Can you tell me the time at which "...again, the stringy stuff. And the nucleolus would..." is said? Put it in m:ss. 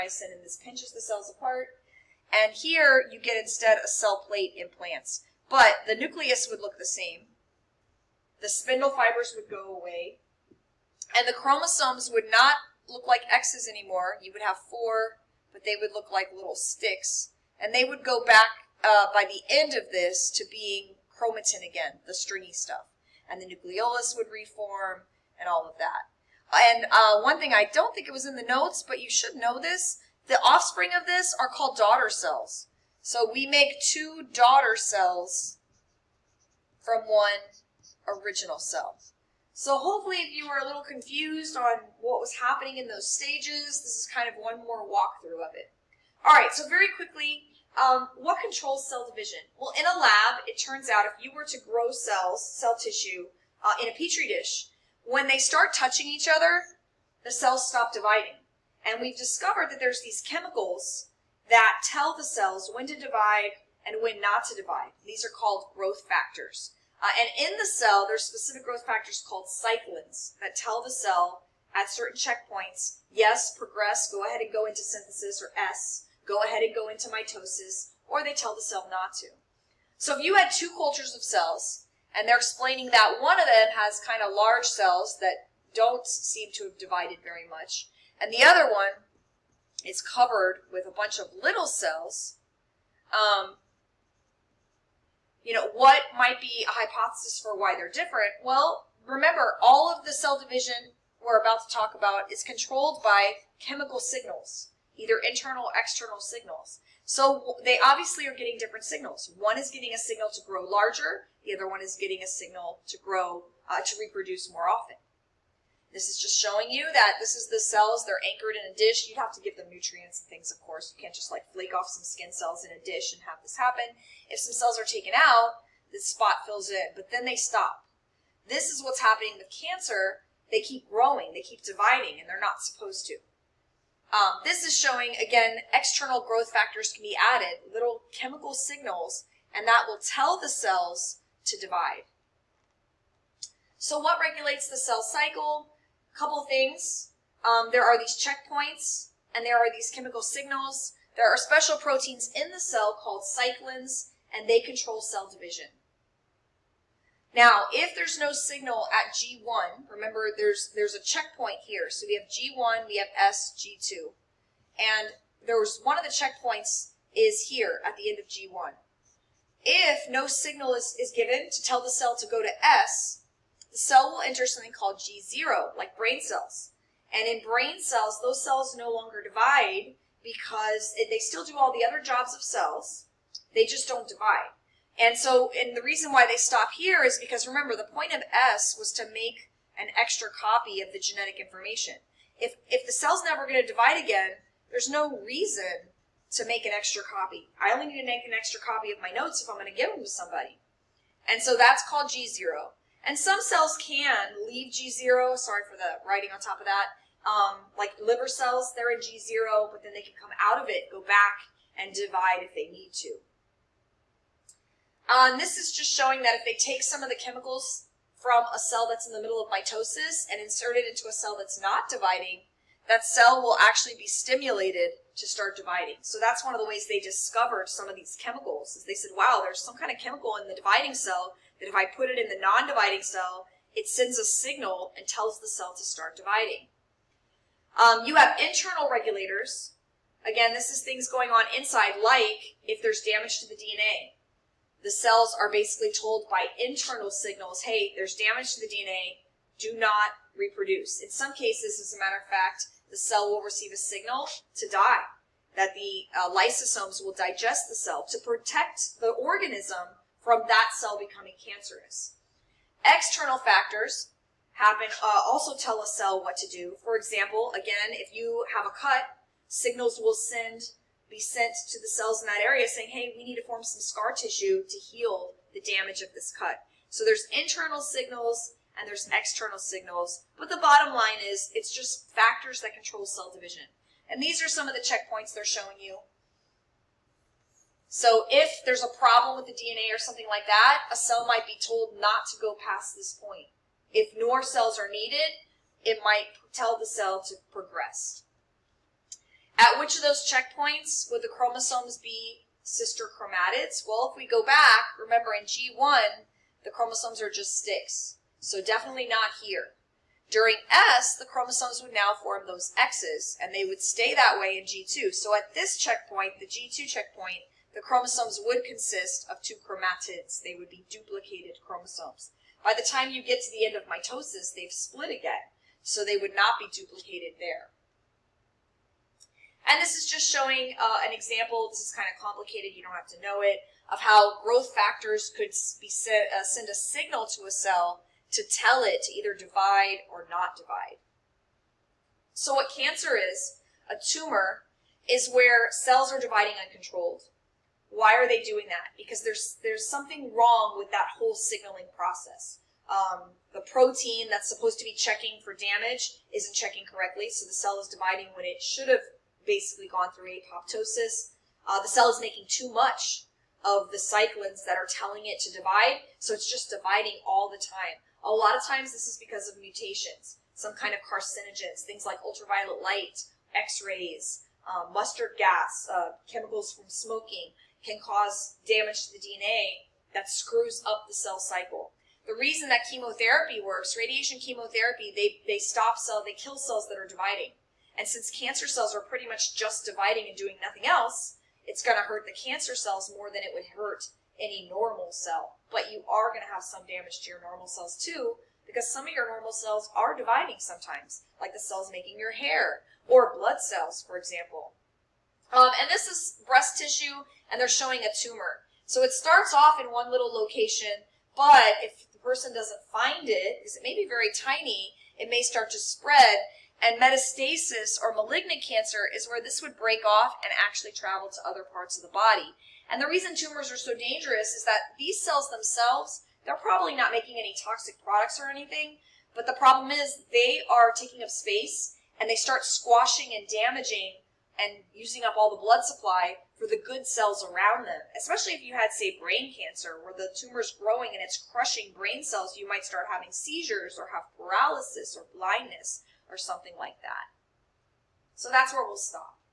0:21.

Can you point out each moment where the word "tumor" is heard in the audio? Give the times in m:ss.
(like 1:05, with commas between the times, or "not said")
5:43, 6:48, 7:03, 7:20.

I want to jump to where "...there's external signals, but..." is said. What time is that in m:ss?
4:38.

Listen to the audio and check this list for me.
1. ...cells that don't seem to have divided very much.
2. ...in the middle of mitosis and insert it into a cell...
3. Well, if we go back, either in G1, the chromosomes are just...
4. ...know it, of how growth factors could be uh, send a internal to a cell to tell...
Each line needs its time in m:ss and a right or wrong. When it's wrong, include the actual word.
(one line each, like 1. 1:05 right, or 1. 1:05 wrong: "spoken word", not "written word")
1. 1:24 right
2. 3:39 right
3. 5:03 wrong: "remember", not "either"
4. 5:33 wrong: "signal", not "internal".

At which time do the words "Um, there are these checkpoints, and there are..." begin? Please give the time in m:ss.
2:27.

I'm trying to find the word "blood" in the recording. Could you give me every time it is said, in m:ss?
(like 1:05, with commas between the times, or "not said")
6:43, 7:15.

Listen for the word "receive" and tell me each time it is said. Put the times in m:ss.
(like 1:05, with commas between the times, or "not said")
4:13.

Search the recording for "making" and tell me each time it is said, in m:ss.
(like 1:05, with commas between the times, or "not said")
6:02, 6:41, 7:07.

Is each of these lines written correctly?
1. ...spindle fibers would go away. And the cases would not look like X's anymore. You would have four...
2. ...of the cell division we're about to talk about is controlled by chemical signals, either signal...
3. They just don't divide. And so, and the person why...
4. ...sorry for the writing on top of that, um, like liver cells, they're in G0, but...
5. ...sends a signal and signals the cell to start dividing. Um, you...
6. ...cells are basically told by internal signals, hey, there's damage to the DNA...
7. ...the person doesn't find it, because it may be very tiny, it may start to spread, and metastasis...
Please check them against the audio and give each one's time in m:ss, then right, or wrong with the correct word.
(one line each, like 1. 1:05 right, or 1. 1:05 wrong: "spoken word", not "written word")
1. 0:08 wrong: "chromosomes", not "cases"
2. 1:39 wrong: "internal", not "signal"
3. 3:03 wrong: "reason", not "person"
4. 3:25 right
5. 3:53 wrong: "tells", not "signals"
6. 4:04 right
7. 6:52 right.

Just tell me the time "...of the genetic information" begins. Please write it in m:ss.
3:10.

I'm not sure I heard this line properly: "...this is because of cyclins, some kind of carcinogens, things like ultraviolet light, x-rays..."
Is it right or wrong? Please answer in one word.
wrong.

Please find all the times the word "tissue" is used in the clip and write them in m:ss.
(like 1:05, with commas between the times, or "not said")
0:52, 4:34, 6:46.